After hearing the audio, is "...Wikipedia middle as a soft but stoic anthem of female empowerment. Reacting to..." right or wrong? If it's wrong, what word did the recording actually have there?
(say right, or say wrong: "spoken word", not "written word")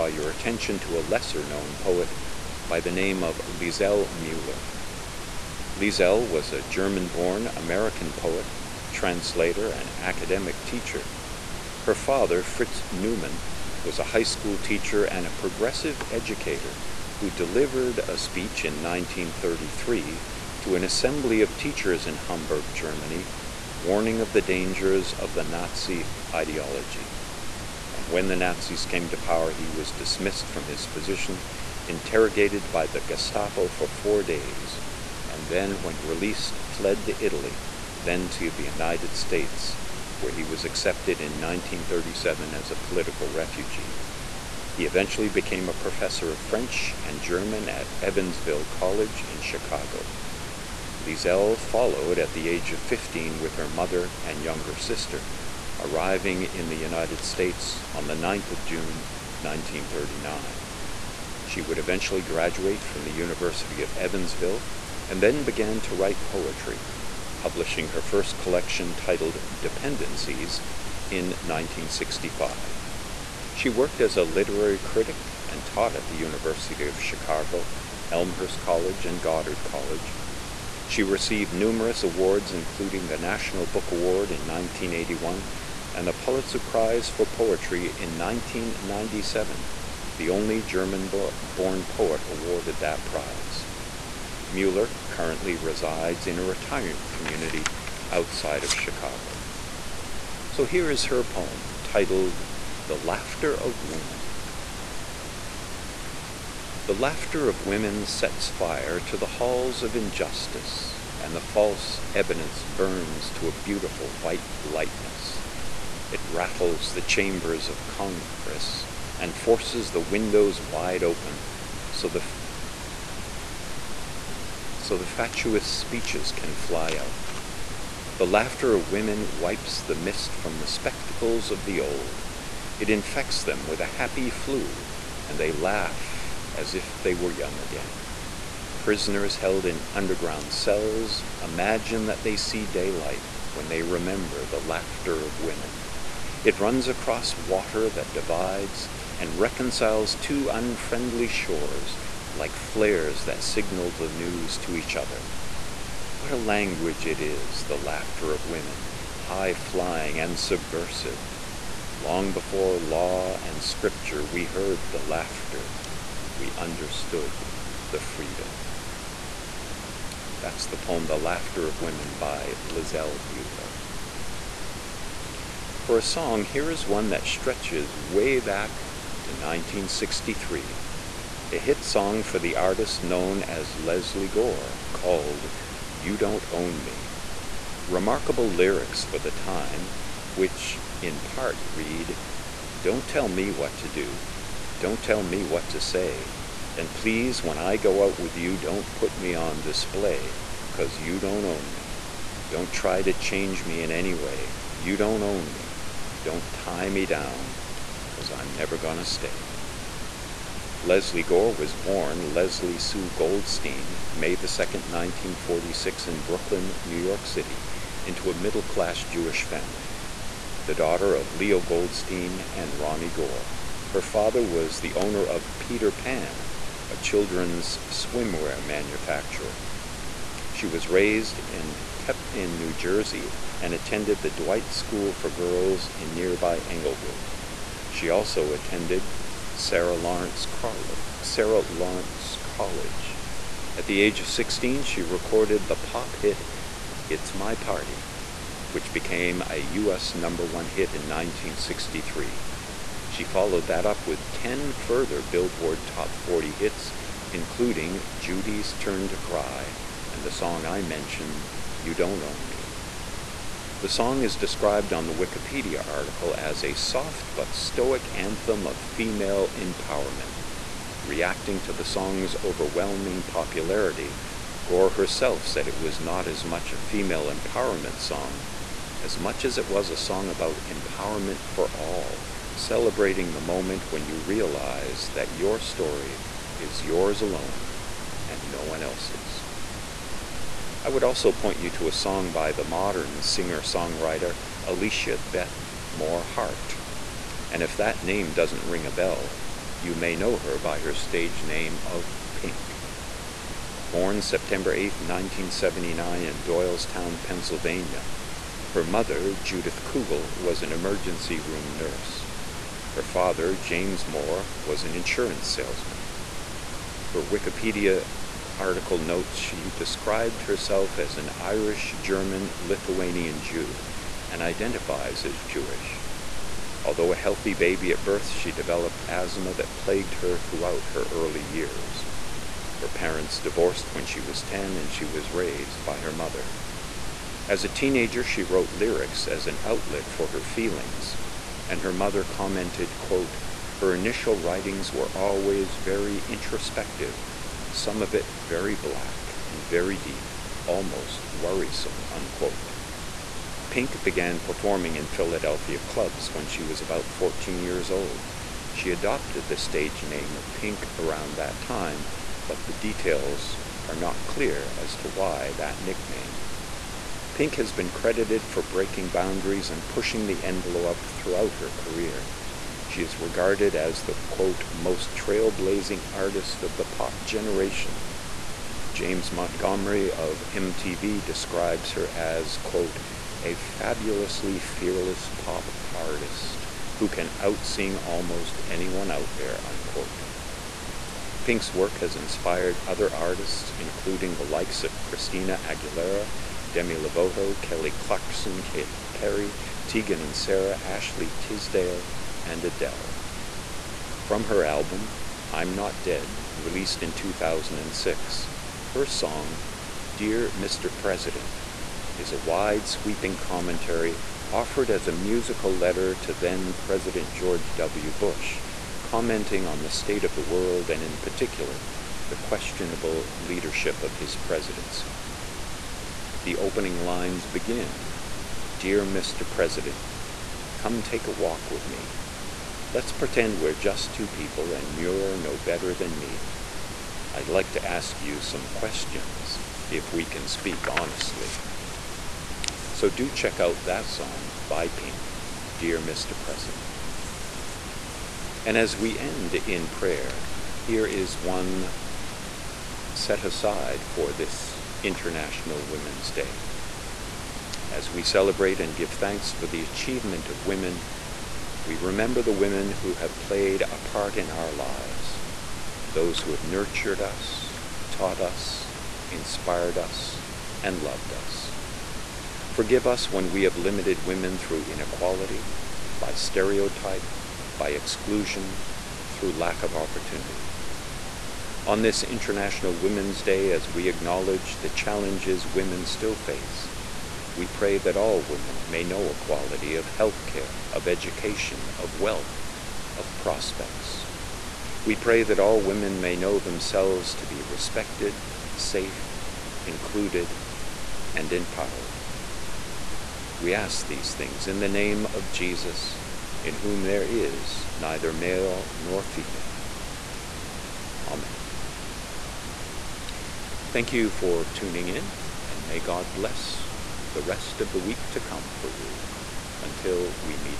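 wrong: "article", not "middle".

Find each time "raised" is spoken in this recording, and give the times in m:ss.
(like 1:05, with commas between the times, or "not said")
3:50, 5:35.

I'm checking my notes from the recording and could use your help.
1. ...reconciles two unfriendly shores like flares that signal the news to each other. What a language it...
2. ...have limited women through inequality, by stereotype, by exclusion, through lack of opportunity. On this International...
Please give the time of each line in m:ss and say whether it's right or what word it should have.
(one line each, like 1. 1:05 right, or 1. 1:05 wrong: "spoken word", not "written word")
1. 2:29 right
2. 7:53 right.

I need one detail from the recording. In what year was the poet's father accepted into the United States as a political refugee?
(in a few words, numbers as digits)
1937.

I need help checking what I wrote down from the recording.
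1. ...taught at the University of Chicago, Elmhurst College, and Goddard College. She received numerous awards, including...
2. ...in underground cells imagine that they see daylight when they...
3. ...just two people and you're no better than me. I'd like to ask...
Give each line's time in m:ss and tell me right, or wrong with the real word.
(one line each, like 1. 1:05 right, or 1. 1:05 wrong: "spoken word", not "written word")
1. 1:15 right
2. 2:19 right
3. 7:13 right.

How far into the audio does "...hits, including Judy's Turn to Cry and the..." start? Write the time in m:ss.
4:16.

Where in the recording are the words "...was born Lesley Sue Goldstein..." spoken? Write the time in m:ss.
3:31.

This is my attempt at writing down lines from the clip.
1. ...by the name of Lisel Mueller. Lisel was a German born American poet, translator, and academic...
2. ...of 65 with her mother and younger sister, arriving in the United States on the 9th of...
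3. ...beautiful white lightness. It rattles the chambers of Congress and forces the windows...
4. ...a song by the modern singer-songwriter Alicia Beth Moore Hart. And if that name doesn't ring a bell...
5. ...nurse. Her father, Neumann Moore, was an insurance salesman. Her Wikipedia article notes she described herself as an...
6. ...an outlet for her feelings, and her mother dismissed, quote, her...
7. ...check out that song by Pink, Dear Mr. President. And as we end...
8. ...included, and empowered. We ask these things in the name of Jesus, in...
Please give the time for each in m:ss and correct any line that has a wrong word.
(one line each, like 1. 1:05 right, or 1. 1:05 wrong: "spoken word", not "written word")
1. 0:02 right
2. 0:52 wrong: "15", not "65"
3. 1:53 right
4. 4:51 right
5. 5:11 wrong: "James", not "Neumann"
6. 5:39 wrong: "commented", not "dismissed"
7. 7:23 right
8. 8:19 right.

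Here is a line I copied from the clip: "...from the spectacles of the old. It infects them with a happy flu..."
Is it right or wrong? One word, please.
right.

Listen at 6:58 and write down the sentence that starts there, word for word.
Bush, commenting on the state of the world and, in particular, the questionable leadership of his presidency.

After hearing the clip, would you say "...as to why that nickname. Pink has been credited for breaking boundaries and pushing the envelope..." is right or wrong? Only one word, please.
right.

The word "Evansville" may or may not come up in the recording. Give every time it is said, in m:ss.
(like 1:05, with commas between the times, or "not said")
0:48, 1:03.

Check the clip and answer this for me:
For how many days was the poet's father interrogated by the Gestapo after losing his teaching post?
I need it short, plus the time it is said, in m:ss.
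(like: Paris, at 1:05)
4, at 0:33.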